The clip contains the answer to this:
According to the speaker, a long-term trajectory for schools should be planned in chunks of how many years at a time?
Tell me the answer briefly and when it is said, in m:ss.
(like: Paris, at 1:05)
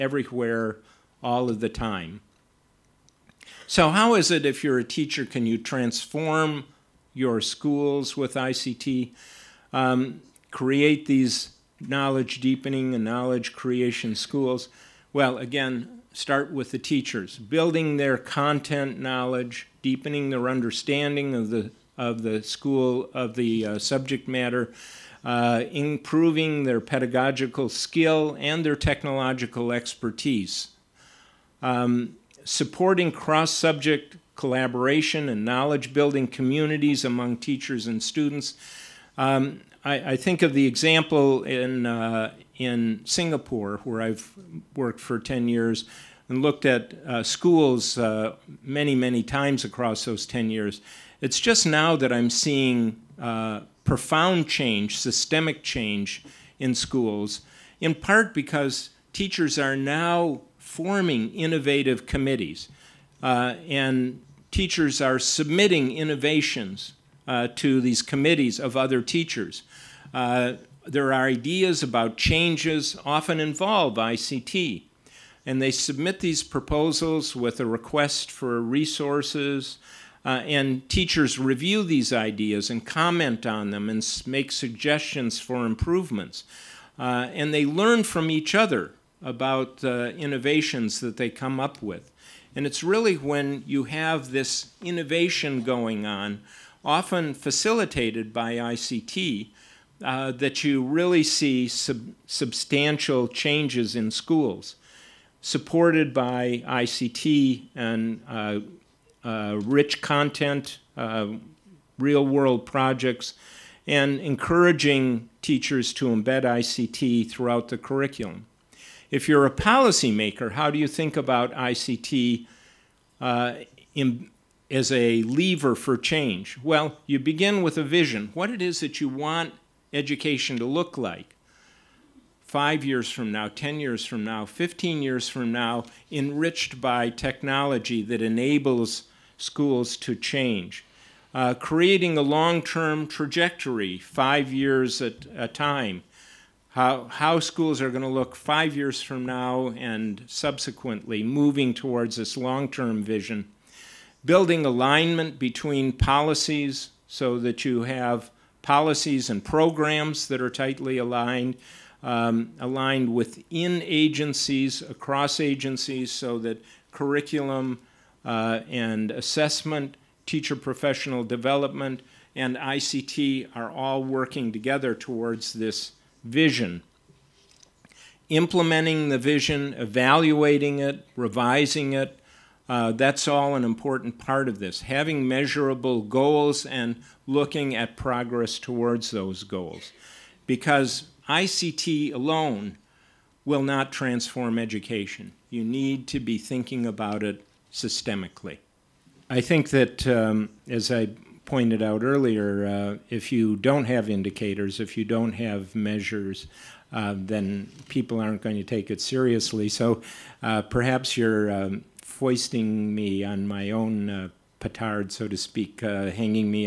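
5, at 2:23.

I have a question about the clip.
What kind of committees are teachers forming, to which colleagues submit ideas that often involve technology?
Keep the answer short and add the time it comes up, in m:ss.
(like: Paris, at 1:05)
innovative committees, at 1:01.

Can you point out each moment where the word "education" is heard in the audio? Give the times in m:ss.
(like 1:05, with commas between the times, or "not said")
2:09, 3:14.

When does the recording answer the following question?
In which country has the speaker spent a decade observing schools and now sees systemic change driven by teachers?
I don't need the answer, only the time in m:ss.
0:43.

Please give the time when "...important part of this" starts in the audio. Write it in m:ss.
3:03.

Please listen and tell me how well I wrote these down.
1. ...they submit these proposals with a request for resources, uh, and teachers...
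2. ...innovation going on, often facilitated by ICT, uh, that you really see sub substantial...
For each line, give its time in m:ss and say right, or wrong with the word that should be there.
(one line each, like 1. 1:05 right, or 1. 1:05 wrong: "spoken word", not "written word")
1. 1:15 right
2. 1:34 right.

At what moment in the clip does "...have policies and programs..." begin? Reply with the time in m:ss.
2:37.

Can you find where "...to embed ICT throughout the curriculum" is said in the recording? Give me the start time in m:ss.
1:55.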